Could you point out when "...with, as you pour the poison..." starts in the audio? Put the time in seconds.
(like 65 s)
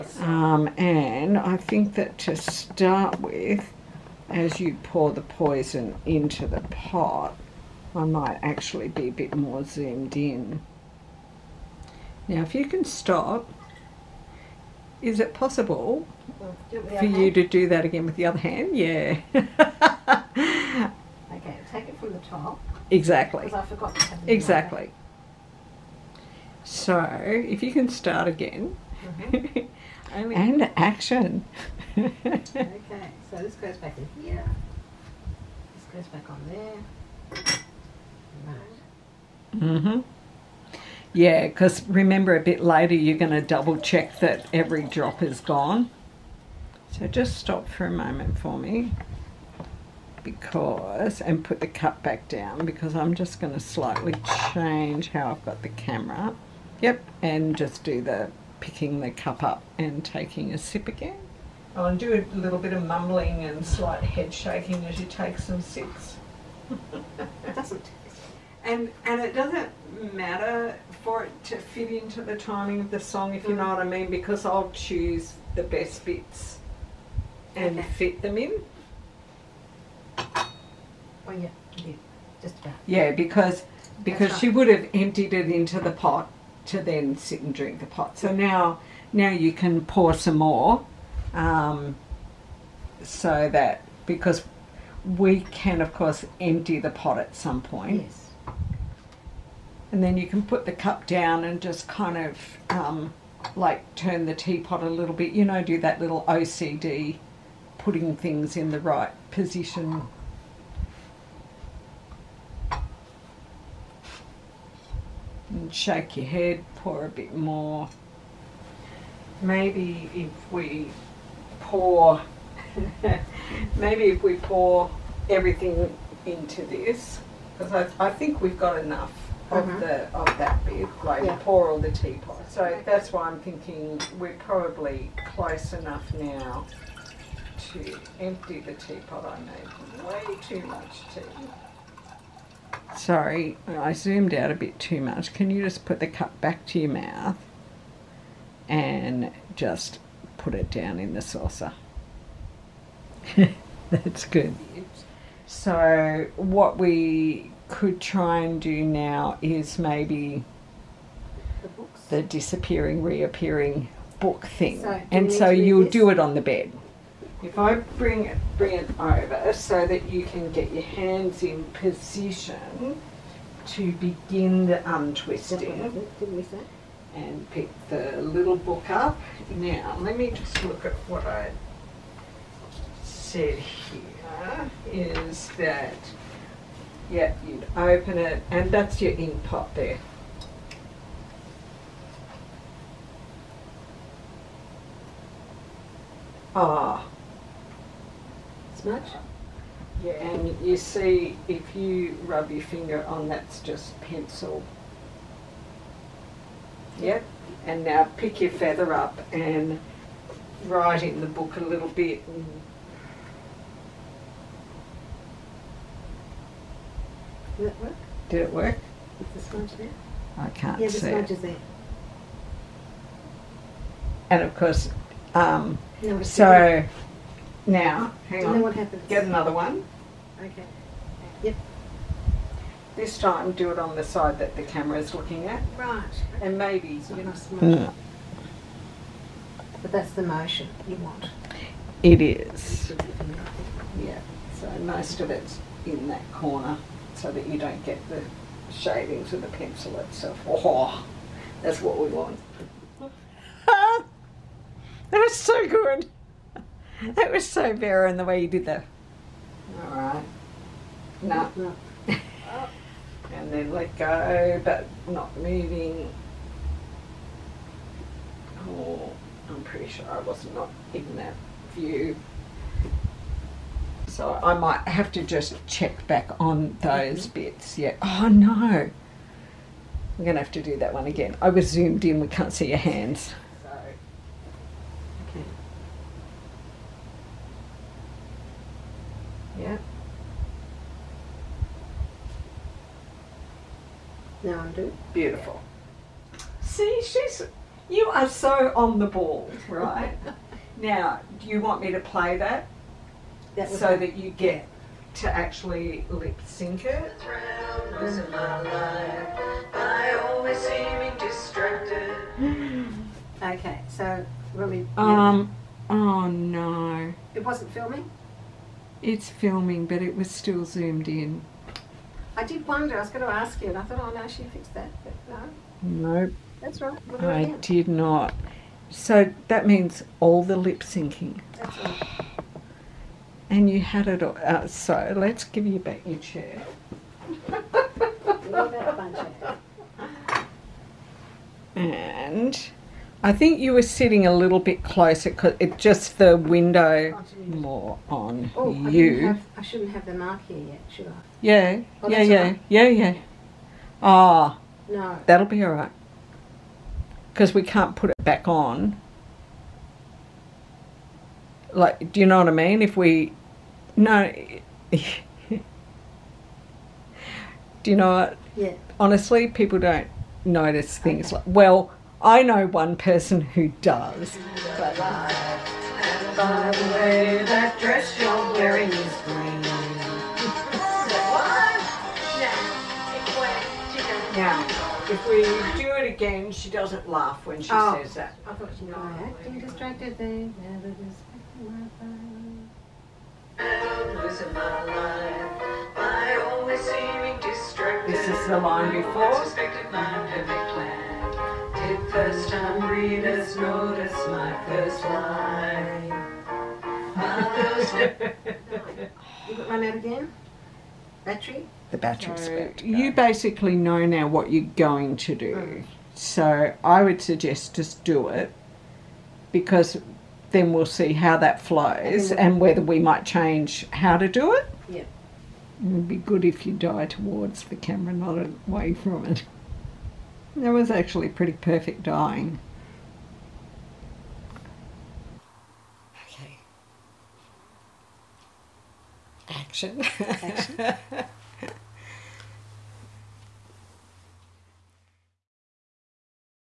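3 s.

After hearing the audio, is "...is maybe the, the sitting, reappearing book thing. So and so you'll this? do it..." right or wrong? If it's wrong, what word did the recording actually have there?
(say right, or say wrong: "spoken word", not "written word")
wrong: "disappearing", not "sitting".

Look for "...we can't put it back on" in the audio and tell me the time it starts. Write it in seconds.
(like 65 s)
357 s.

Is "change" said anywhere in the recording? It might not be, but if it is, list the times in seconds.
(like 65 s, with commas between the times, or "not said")
54 s, 423 s.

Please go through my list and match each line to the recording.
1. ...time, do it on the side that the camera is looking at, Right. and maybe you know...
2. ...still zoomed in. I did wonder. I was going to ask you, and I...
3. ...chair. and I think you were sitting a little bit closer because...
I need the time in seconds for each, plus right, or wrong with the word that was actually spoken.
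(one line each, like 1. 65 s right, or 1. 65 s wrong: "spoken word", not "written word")
1. 233 s right
2. 320 s right
3. 336 s right.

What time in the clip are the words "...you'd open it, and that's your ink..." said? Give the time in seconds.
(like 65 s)
187 s.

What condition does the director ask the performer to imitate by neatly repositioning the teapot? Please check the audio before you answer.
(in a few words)
OCD.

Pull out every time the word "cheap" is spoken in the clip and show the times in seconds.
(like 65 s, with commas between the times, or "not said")
not said.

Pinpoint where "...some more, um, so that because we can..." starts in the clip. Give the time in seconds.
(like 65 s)
90 s.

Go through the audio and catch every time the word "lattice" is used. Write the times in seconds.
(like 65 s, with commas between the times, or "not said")
not said.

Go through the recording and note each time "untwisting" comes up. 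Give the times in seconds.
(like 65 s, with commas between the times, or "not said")
174 s.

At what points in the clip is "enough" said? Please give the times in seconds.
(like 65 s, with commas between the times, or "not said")
128 s, 135 s.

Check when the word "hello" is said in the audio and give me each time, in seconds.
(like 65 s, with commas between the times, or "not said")
not said.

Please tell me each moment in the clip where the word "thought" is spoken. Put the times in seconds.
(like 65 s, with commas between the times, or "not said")
323 s, 388 s.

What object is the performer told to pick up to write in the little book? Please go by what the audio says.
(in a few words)
feather.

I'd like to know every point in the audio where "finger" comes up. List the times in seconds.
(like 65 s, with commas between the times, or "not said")
202 s.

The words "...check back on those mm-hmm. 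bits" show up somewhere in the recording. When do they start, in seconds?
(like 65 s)
275 s.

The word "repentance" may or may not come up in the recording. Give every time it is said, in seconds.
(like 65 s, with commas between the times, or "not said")
not said.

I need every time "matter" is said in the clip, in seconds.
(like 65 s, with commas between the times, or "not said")
70 s.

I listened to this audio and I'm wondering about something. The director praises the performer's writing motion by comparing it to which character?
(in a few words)
Verin.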